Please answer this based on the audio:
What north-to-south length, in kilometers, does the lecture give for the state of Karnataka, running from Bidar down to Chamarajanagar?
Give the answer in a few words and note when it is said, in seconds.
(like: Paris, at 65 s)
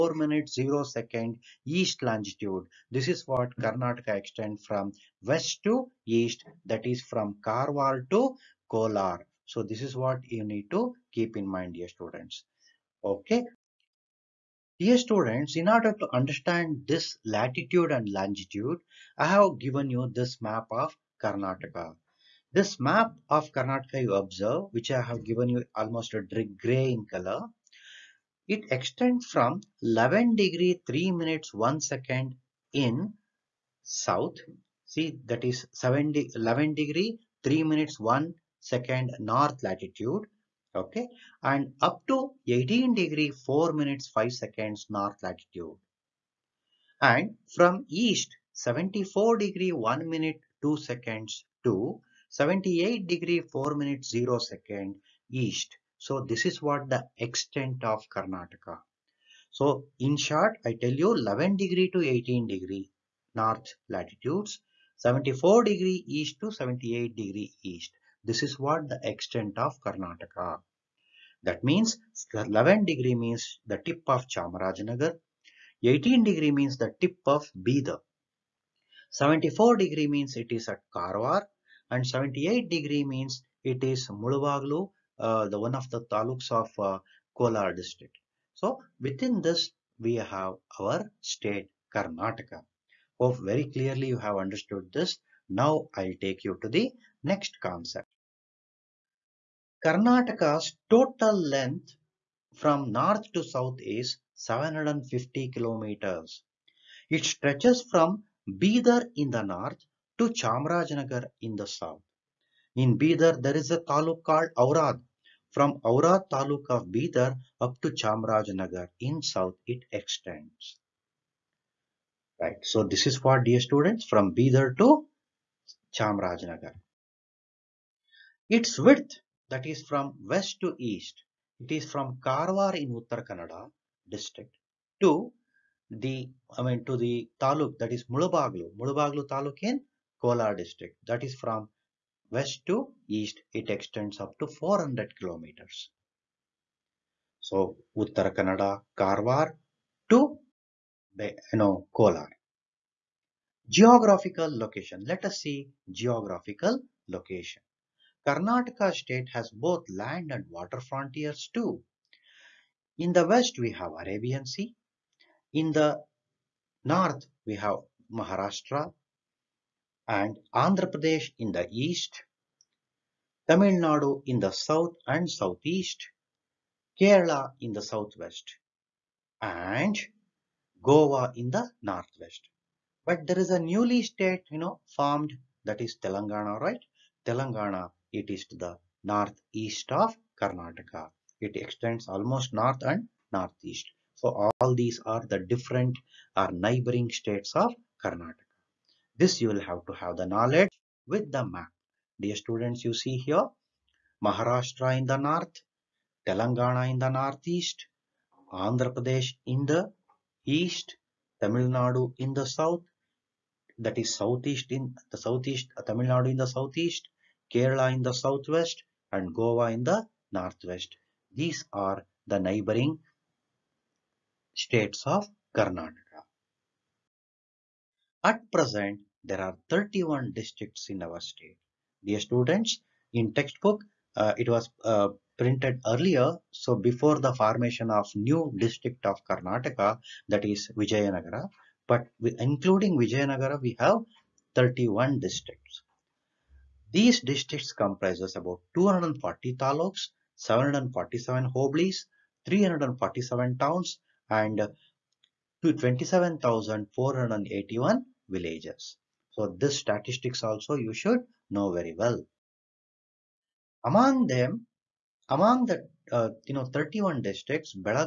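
750 kilometers, at 104 s.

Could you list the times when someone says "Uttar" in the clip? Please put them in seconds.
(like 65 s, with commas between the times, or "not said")
132 s, 147 s.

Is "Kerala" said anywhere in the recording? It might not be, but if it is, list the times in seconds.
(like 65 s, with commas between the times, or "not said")
176 s, 217 s.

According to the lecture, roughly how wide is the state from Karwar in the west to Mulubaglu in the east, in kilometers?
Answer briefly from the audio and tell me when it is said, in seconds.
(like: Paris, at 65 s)
400 kilometers, at 144 s.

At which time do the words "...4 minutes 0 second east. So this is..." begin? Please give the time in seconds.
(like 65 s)
53 s.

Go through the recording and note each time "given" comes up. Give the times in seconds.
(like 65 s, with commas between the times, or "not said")
19 s, 25 s.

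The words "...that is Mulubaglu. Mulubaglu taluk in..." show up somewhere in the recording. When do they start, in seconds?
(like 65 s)
137 s.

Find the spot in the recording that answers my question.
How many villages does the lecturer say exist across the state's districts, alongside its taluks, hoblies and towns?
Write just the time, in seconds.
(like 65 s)
255 s.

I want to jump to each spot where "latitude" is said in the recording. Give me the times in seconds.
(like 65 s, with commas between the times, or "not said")
17 s, 39 s, 45 s, 63 s.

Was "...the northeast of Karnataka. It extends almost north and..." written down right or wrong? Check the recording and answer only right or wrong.
right.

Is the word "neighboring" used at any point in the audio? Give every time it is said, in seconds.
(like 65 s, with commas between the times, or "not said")
196 s, 222 s.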